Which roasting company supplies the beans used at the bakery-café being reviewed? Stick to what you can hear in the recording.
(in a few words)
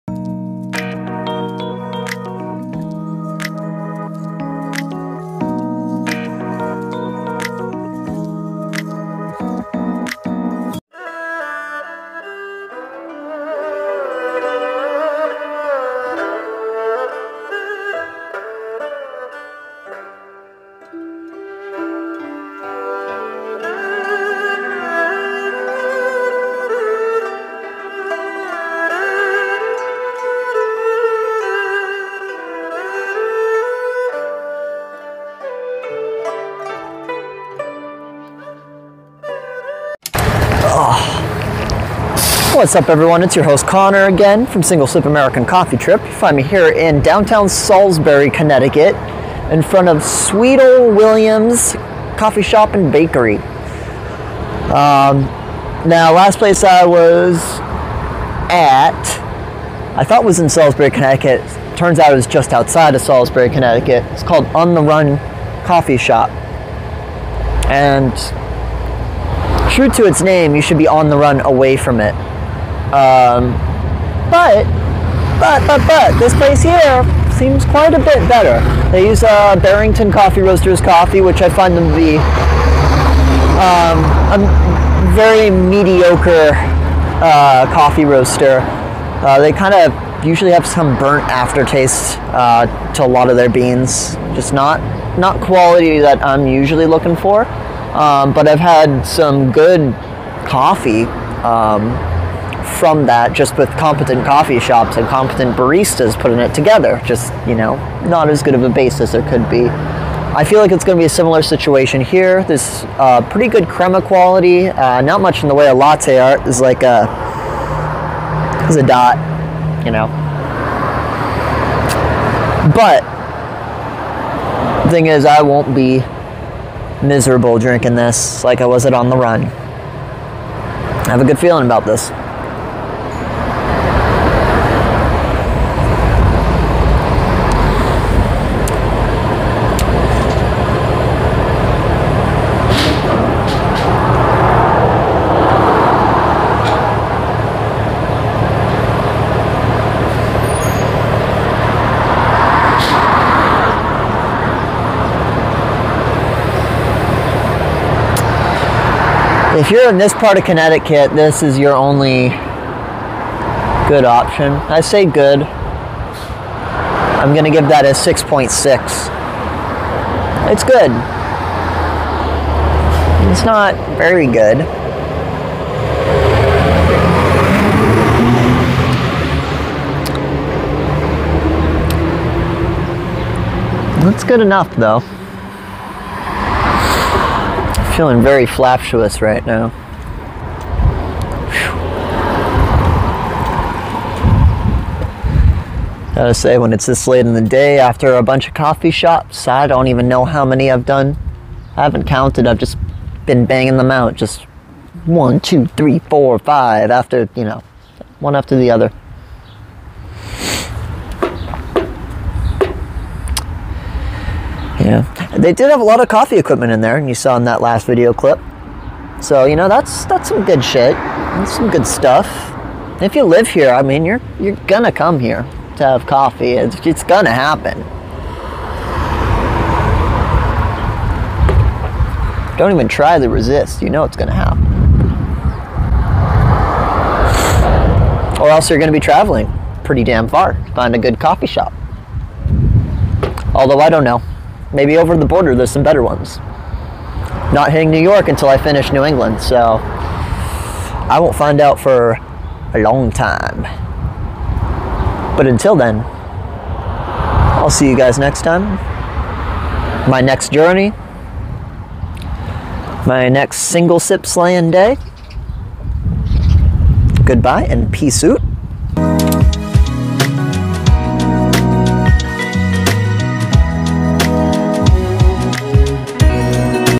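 Barrington Coffee Roasters.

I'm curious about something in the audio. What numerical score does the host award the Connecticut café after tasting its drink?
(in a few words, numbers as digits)
6.6.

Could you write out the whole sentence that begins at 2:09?
I have a good feeling about this.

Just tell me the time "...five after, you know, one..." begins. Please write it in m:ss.
3:26.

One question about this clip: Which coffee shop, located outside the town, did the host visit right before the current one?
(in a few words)
On The Run Coffee Shop.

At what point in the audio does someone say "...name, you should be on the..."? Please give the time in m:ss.
1:10.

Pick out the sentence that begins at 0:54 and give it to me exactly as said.
Um, now last place I was at, I thought was in Salisbury, Connecticut.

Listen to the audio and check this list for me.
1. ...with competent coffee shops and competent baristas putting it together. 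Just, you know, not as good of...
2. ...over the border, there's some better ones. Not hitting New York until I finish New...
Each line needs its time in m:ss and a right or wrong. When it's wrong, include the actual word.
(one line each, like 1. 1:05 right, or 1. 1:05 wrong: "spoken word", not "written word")
1. 1:43 right
2. 4:04 right.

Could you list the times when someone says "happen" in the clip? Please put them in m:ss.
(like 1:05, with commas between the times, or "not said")
3:47, 3:54.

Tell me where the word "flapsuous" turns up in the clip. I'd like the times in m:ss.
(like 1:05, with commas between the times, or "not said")
3:08.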